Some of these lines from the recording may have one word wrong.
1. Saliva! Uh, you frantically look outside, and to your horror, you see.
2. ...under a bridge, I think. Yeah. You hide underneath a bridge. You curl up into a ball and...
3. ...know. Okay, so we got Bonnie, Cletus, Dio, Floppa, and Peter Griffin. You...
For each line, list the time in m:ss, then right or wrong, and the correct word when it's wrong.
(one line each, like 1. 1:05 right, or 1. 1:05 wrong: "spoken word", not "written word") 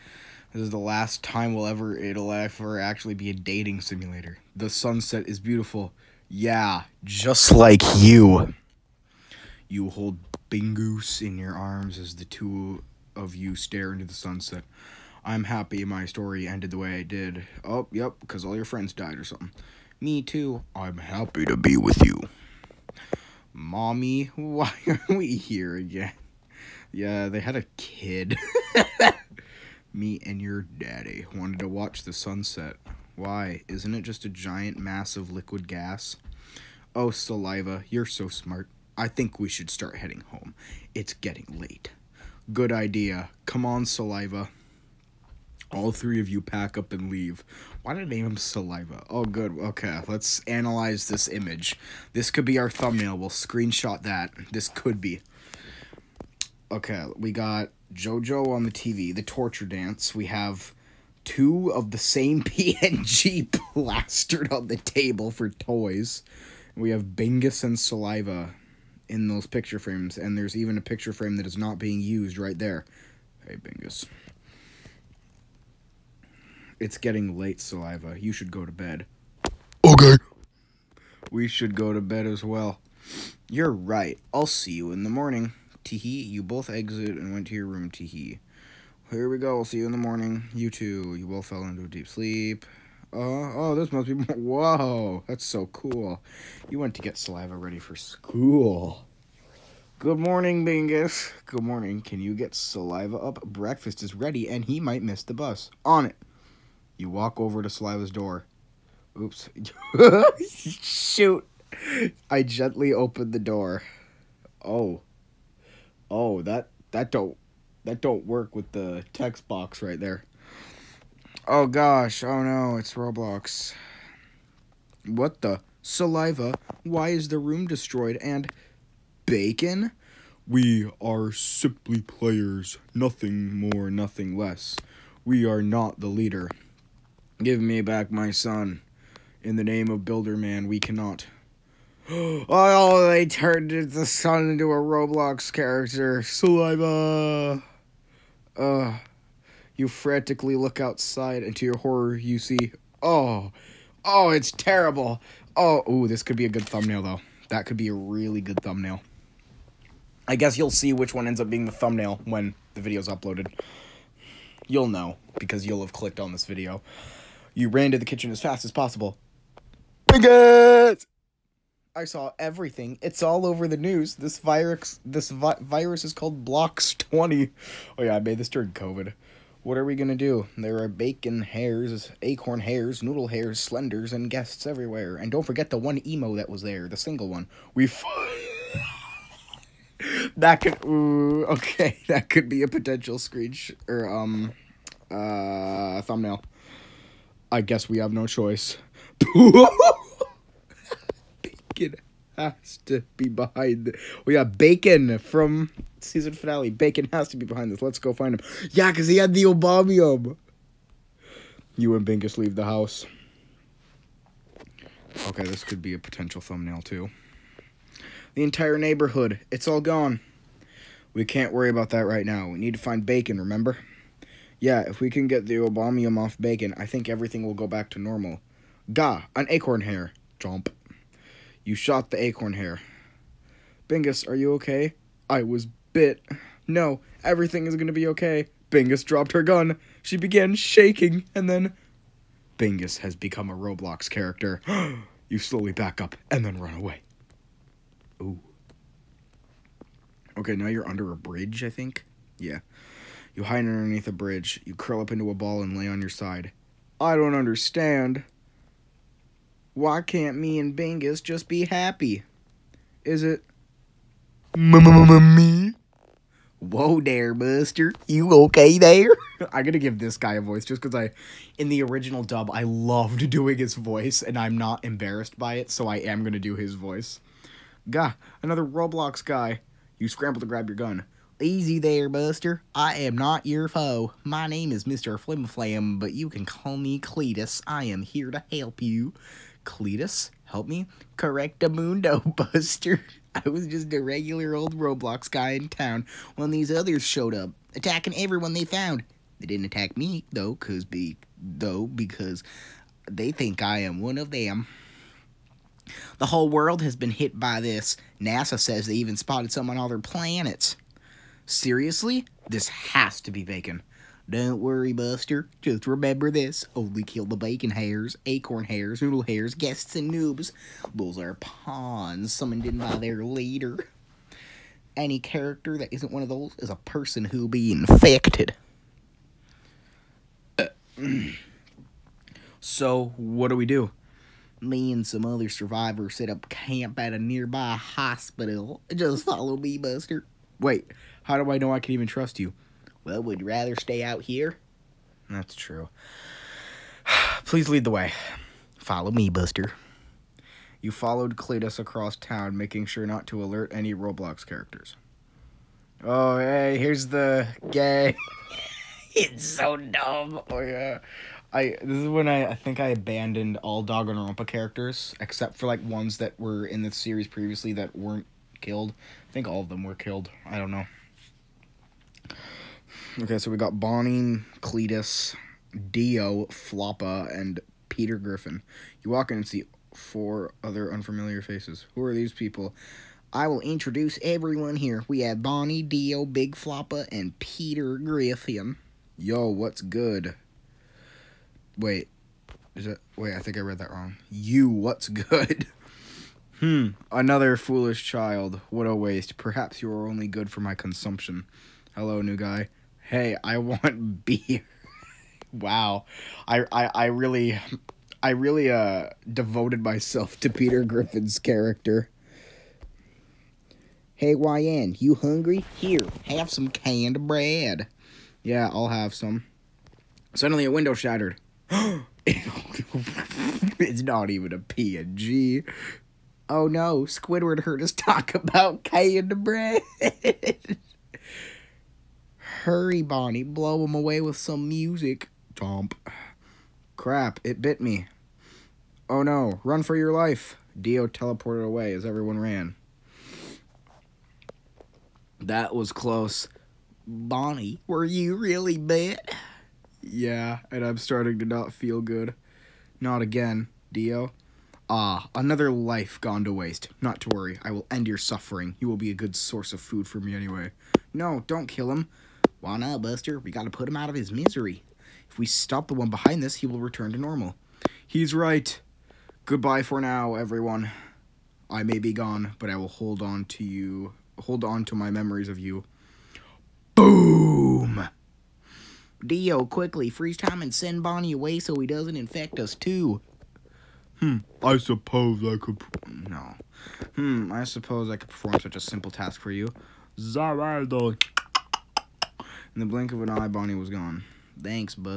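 1. 2:26 right
2. 4:10 right
3. 6:10 right.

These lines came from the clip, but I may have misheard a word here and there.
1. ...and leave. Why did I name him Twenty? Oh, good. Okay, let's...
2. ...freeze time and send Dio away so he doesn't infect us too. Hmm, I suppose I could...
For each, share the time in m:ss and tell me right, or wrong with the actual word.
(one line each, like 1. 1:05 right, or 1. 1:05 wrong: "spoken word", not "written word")
1. 0:46 wrong: "Saliva", not "Twenty"
2. 8:00 wrong: "Bonnie", not "Dio".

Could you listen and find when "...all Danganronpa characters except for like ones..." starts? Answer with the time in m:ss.
6:03.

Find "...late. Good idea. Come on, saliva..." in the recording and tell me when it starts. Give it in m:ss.
0:41.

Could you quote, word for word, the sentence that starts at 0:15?
I'm happy my story ended the way I did.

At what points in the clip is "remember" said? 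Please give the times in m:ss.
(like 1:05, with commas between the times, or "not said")
3:43, 5:15.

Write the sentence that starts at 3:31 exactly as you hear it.
You and Bingus leave the house.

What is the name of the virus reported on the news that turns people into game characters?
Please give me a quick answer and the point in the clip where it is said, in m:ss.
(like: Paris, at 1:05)
Blocks Twenty, at 2:54.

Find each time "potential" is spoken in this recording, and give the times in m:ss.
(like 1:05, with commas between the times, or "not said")
3:12, 3:35.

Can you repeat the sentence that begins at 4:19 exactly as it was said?
Why can't me and Bingus just be happy?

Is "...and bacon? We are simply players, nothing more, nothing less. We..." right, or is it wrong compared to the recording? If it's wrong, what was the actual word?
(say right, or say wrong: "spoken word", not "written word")
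right.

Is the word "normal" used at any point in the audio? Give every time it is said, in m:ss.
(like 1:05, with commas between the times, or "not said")
3:47, 7:47.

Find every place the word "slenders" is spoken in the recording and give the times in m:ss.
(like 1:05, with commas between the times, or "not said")
3:03.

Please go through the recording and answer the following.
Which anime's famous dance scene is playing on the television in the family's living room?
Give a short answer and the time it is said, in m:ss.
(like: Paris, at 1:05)
JoJo, at 0:57.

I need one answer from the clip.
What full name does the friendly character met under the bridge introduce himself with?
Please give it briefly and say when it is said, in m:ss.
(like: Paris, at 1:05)
Mr. Flimflam, at 4:44.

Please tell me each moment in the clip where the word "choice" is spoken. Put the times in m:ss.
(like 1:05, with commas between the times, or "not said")
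3:18.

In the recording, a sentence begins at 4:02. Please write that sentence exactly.
Bingus has become a Roblox character.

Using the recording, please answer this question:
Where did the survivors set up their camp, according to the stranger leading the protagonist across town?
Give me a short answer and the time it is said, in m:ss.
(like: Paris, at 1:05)
a nearby hospital, at 5:36.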